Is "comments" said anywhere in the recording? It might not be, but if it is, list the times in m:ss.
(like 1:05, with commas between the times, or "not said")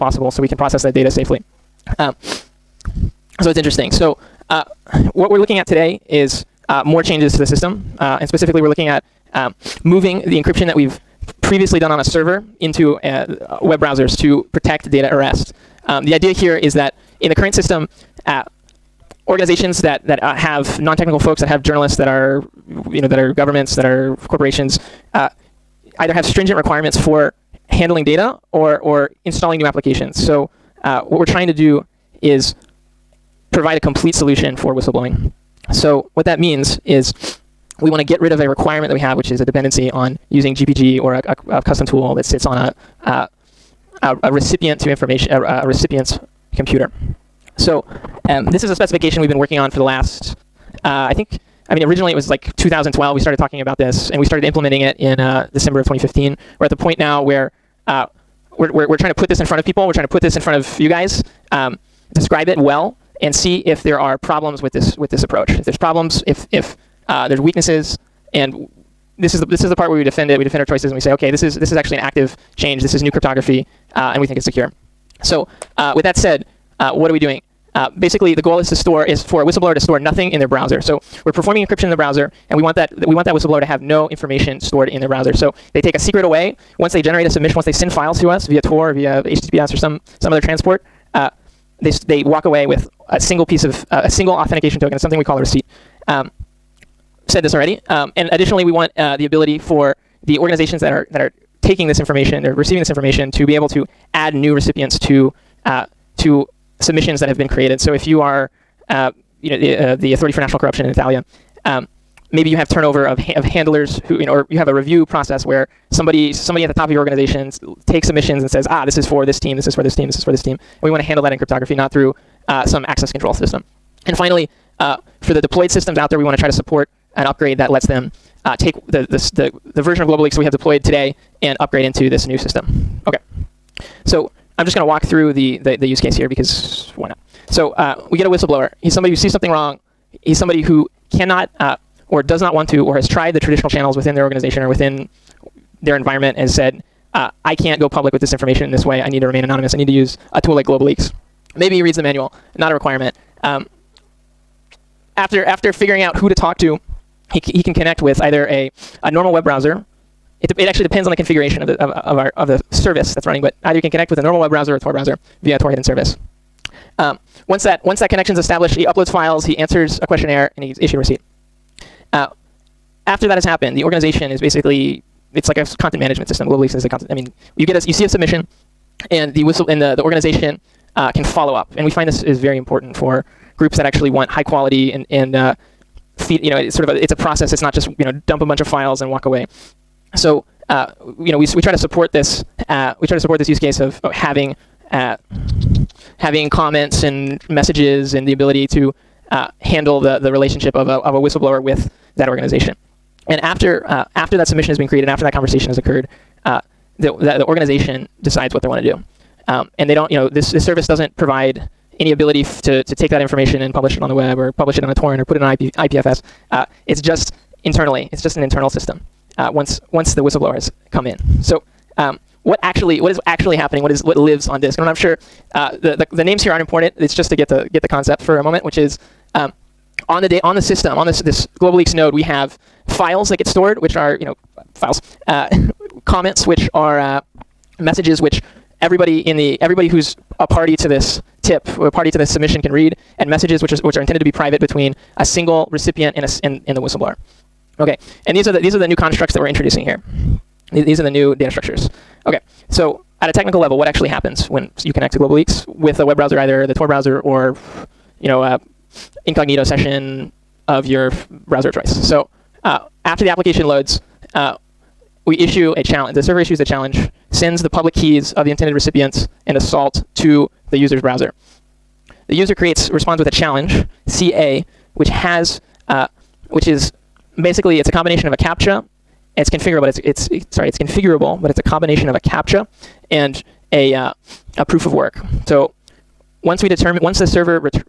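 3:16, 3:56.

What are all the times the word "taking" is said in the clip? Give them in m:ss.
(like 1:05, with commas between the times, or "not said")
1:41.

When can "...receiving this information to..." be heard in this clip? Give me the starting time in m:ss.
1:42.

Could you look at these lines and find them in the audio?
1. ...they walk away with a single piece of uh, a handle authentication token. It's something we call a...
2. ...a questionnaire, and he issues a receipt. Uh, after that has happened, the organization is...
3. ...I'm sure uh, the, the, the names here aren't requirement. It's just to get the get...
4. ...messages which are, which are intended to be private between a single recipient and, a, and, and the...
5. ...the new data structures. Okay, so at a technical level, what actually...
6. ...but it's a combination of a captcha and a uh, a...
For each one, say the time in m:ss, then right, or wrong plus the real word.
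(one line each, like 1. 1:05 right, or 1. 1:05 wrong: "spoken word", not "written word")
1. 1:32 wrong: "single", not "handle"
2. 2:50 right
3. 3:44 wrong: "important", not "requirement"
4. 4:03 right
5. 4:11 right
6. 4:41 right.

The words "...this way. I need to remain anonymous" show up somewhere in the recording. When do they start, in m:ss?
2:28.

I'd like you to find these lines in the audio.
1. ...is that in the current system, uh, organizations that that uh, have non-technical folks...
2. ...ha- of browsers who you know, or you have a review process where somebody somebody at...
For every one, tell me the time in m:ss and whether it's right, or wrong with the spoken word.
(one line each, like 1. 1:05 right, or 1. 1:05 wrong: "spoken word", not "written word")
1. 0:16 right
2. 1:53 wrong: "handlers", not "browsers".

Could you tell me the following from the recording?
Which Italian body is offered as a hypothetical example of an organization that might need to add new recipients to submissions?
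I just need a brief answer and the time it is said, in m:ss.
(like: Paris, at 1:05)
Authority for National Corruption, at 1:50.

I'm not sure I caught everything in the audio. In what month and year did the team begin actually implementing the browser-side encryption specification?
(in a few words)
December 2015.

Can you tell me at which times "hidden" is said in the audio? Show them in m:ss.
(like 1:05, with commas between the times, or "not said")
2:45.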